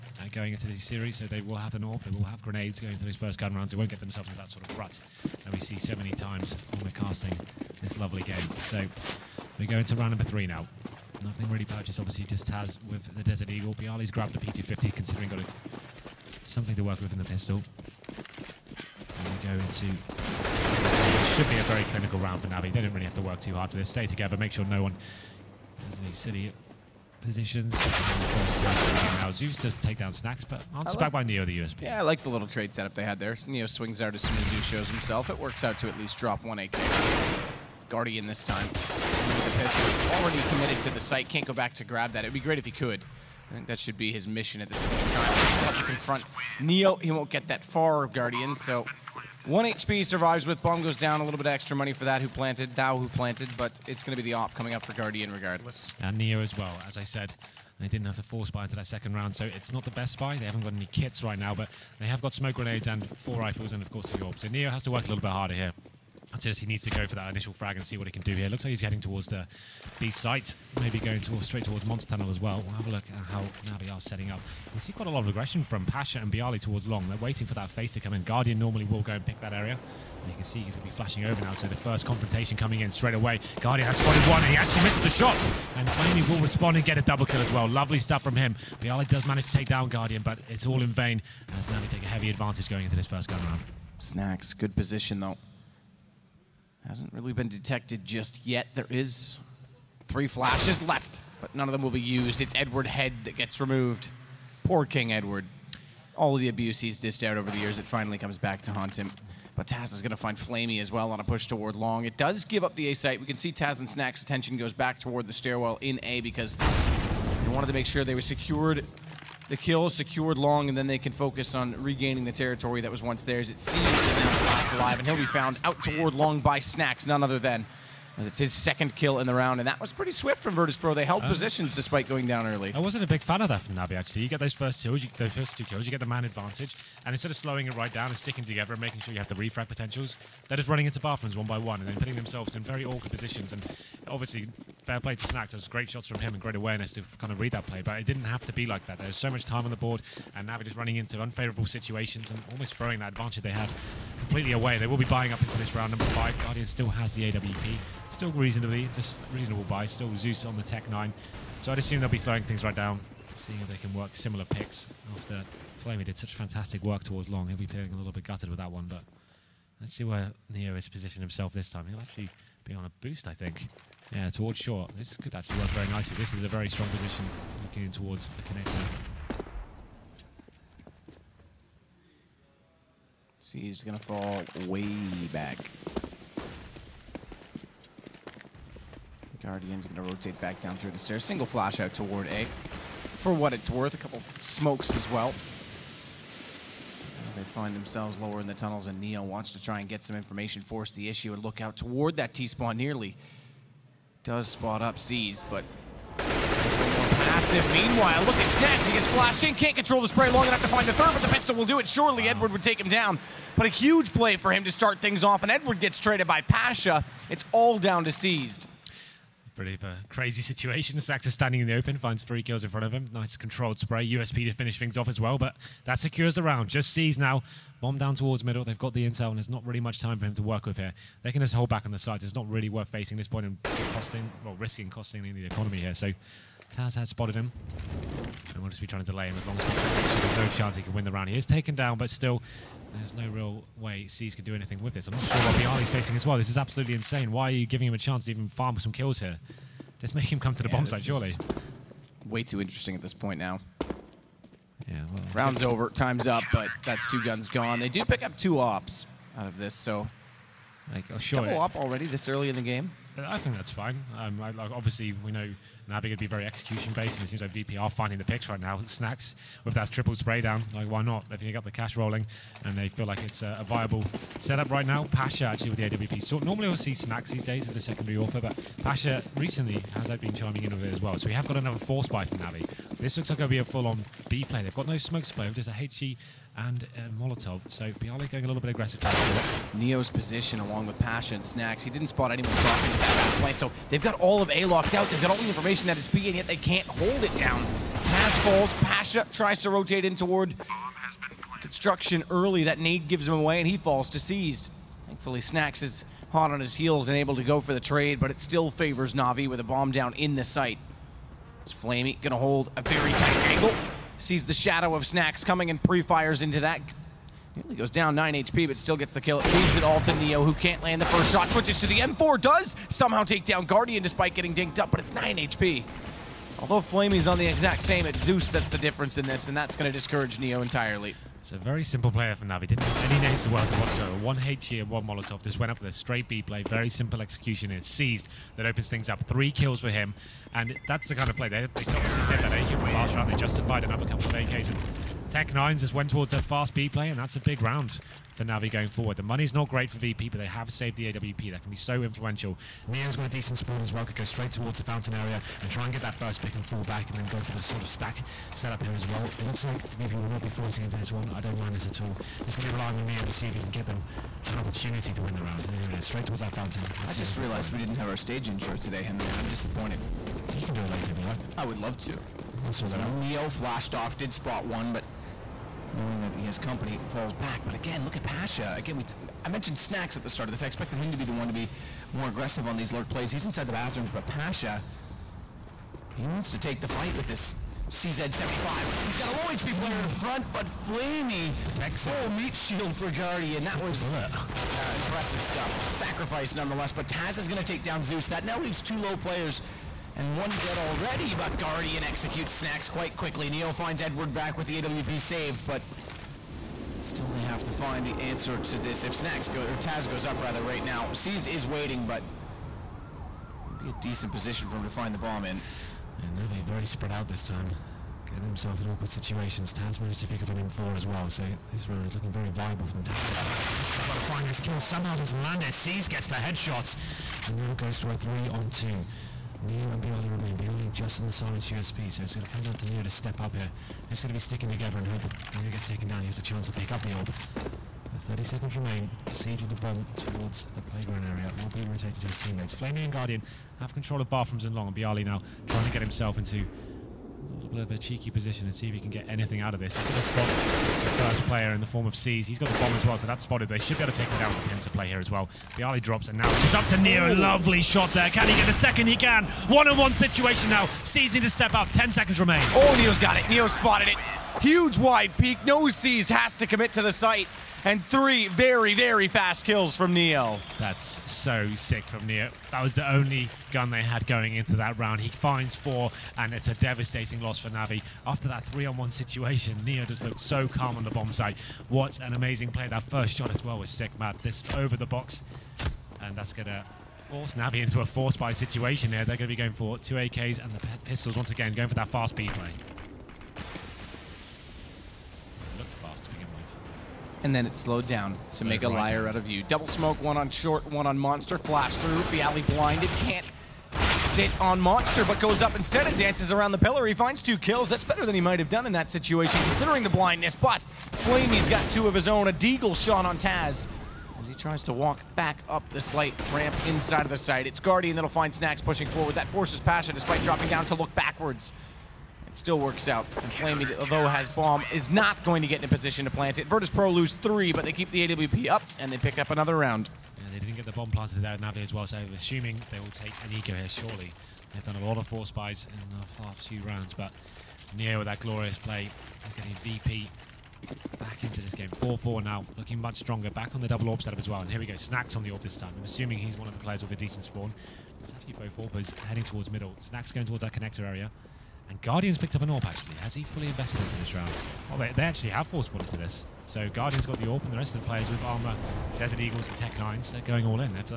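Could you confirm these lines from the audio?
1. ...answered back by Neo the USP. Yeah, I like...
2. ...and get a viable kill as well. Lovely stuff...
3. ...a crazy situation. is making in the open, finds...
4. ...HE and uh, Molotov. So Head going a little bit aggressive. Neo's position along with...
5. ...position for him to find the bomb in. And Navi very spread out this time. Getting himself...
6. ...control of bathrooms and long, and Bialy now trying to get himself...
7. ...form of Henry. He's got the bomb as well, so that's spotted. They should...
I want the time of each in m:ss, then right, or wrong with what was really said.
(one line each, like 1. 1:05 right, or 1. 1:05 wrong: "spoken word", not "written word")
1. 0:30 right
2. 1:26 wrong: "double", not "viable"
3. 3:39 wrong: "standing", not "making"
4. 4:45 wrong: "Bialy", not "Head"
5. 6:54 right
6. 7:23 right
7. 7:31 wrong: "Seized", not "Henry".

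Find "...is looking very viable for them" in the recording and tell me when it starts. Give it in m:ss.
7:02.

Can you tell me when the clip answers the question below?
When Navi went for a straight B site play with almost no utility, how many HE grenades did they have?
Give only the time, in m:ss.
5:34.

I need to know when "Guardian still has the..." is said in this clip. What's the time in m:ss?
2:36.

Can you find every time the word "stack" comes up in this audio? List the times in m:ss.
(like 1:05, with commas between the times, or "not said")
5:57.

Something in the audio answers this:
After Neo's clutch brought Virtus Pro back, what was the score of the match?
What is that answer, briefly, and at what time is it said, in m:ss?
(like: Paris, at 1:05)
4-4, at 9:01.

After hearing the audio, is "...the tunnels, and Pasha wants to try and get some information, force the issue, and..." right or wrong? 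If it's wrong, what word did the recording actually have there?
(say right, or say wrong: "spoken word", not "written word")
wrong: "Neo", not "Pasha".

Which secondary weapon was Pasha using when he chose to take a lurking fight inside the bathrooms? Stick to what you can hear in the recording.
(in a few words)
CZ75.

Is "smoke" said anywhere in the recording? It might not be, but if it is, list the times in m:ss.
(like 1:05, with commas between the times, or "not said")
1:02, 3:14, 4:44, 8:19.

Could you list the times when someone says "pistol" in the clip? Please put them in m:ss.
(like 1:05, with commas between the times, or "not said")
0:17, 3:31, 8:11.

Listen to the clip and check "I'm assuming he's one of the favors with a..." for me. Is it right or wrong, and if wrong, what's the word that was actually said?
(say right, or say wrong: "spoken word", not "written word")
wrong: "players", not "favors".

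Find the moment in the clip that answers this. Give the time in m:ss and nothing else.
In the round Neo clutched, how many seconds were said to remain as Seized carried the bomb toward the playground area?
7:18.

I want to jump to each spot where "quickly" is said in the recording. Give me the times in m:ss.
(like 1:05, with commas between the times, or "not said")
6:43.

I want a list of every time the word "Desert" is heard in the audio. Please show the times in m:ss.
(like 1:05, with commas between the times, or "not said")
0:13, 9:19.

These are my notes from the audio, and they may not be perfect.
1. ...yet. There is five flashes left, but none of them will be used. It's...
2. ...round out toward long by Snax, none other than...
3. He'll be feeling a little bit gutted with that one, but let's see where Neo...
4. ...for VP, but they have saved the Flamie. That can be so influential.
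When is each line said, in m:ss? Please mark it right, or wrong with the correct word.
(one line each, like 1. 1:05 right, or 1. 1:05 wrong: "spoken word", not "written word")
1. 1:38 wrong: "three", not "five"
2. 2:05 wrong: "found", not "round"
3. 2:47 right
4. 5:49 wrong: "AWP", not "Flamie".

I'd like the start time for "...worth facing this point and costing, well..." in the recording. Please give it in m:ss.
3:52.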